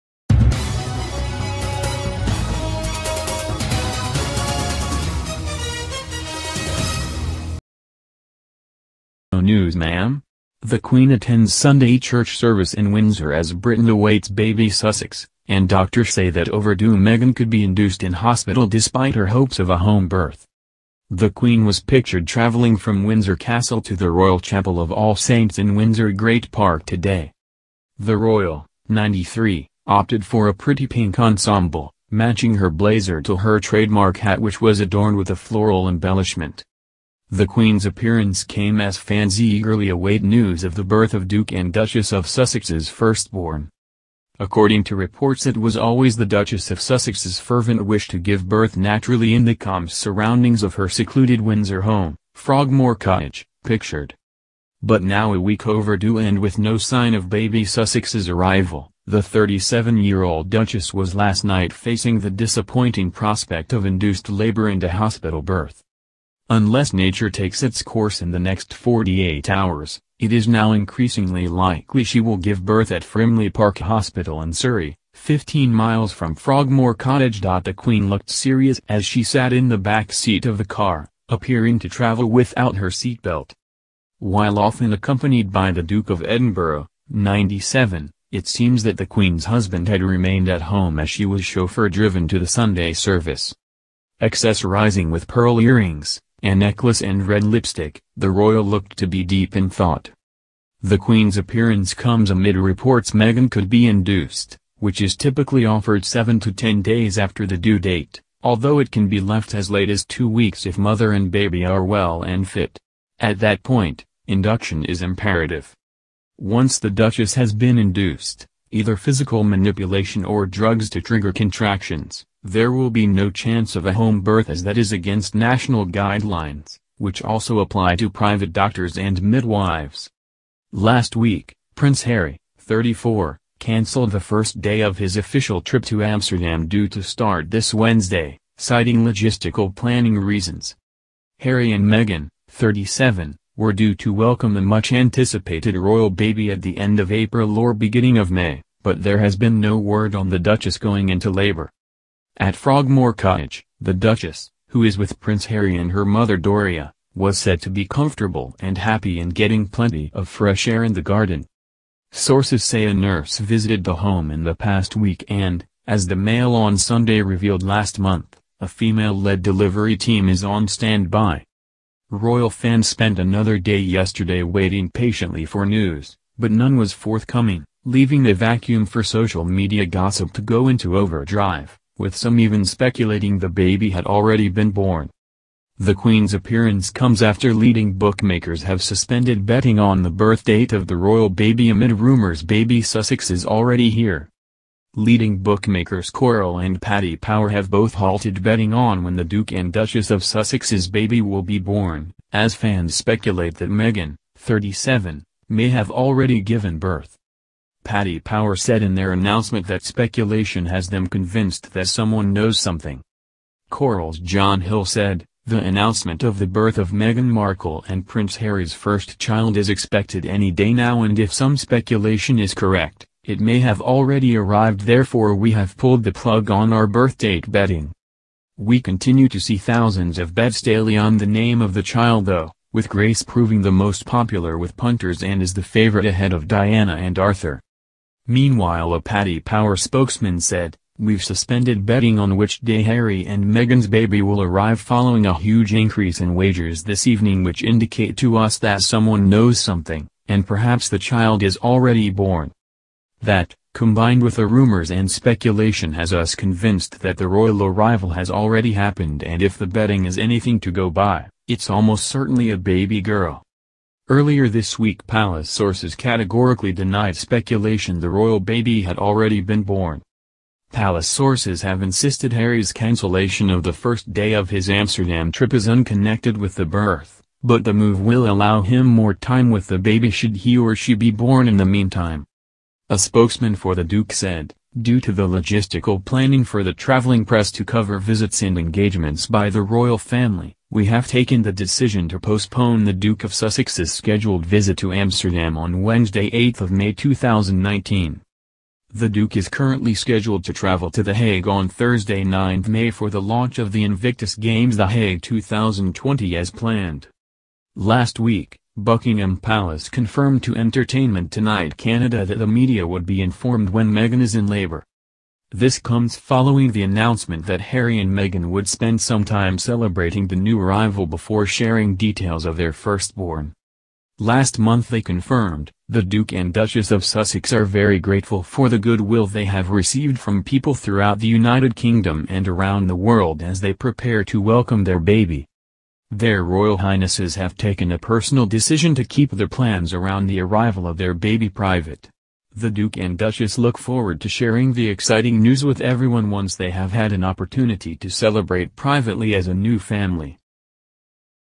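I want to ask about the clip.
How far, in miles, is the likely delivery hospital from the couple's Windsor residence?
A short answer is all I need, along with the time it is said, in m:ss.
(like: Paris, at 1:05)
15 miles, at 1:15.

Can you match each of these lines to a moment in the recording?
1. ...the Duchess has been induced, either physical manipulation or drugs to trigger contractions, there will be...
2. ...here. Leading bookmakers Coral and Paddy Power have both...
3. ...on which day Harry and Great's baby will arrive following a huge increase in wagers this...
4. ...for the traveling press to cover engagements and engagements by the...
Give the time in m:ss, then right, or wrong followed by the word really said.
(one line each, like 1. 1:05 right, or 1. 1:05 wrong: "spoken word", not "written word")
1. 1:56 right
2. 3:13 right
3. 4:02 wrong: "Meghan", not "Great"
4. 4:46 wrong: "visits", not "engagements".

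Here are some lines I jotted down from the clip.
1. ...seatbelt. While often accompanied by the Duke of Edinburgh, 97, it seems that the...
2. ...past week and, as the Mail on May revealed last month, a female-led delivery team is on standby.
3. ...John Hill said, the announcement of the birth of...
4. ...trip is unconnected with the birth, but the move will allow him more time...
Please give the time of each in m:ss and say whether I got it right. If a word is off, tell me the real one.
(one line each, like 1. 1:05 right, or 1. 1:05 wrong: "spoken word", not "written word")
1. 1:22 right
2. 2:44 wrong: "Sunday", not "May"
3. 3:34 right
4. 4:35 right.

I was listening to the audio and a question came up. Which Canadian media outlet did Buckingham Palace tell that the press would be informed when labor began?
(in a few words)
Entertainment Tonight Canada.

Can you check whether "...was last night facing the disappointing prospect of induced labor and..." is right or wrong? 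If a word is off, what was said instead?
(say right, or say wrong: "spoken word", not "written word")
right.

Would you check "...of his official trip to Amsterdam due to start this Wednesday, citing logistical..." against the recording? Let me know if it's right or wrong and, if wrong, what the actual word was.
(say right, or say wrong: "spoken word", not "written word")
right.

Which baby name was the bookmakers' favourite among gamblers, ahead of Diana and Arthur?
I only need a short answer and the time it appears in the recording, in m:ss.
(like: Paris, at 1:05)
Grace, at 3:52.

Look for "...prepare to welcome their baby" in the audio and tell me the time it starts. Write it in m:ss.
5:33.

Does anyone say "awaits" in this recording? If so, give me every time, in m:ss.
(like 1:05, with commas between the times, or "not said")
0:13, 0:39.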